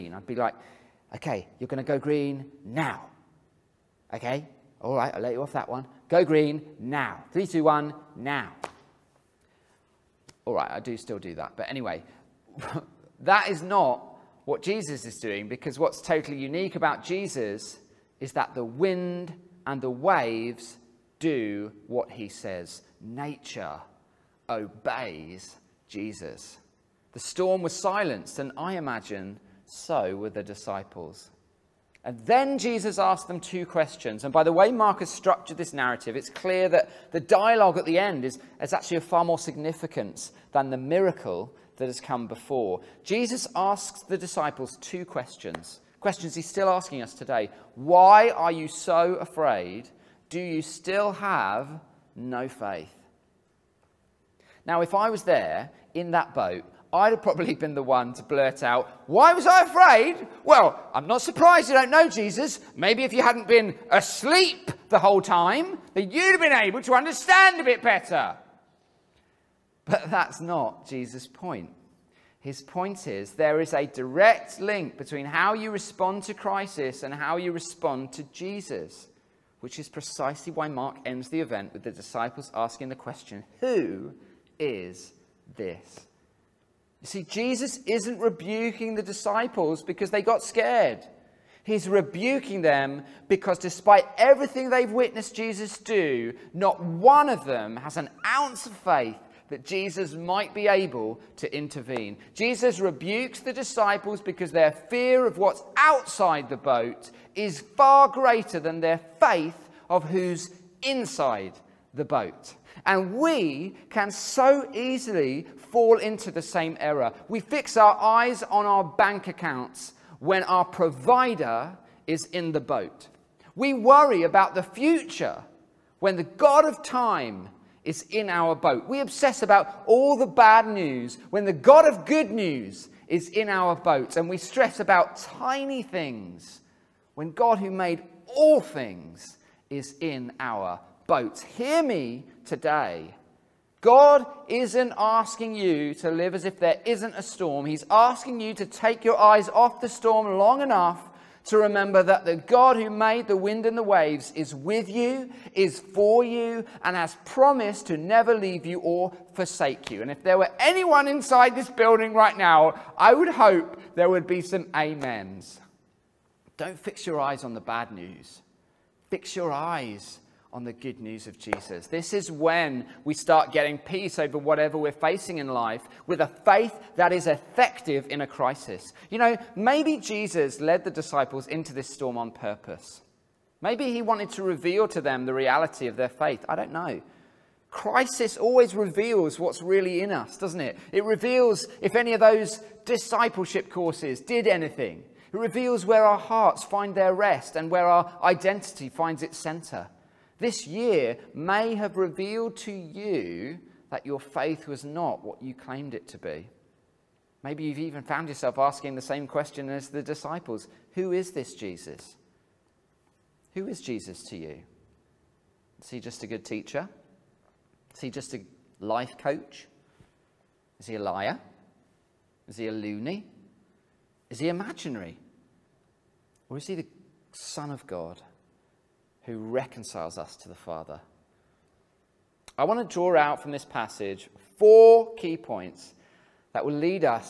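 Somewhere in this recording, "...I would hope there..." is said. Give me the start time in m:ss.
2:42.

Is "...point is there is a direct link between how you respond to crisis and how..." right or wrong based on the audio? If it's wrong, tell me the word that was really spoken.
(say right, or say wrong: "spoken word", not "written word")
right.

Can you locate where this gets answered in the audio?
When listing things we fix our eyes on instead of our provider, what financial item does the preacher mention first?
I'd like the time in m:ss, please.
1:58.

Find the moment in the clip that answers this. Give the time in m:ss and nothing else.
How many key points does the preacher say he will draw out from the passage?
3:54.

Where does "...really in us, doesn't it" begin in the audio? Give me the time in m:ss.
3:09.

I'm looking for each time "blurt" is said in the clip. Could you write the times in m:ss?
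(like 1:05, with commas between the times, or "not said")
0:58.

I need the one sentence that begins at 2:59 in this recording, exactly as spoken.
You know, maybe Jesus led the disciples into this storm on purpose.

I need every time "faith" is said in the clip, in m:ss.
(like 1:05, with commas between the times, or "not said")
0:52, 1:38, 1:49, 2:56, 3:06, 3:24.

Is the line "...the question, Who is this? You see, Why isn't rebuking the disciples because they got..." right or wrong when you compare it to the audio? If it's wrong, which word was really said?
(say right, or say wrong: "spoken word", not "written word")
wrong: "Jesus", not "Why".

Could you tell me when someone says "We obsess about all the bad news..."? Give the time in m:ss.
2:08.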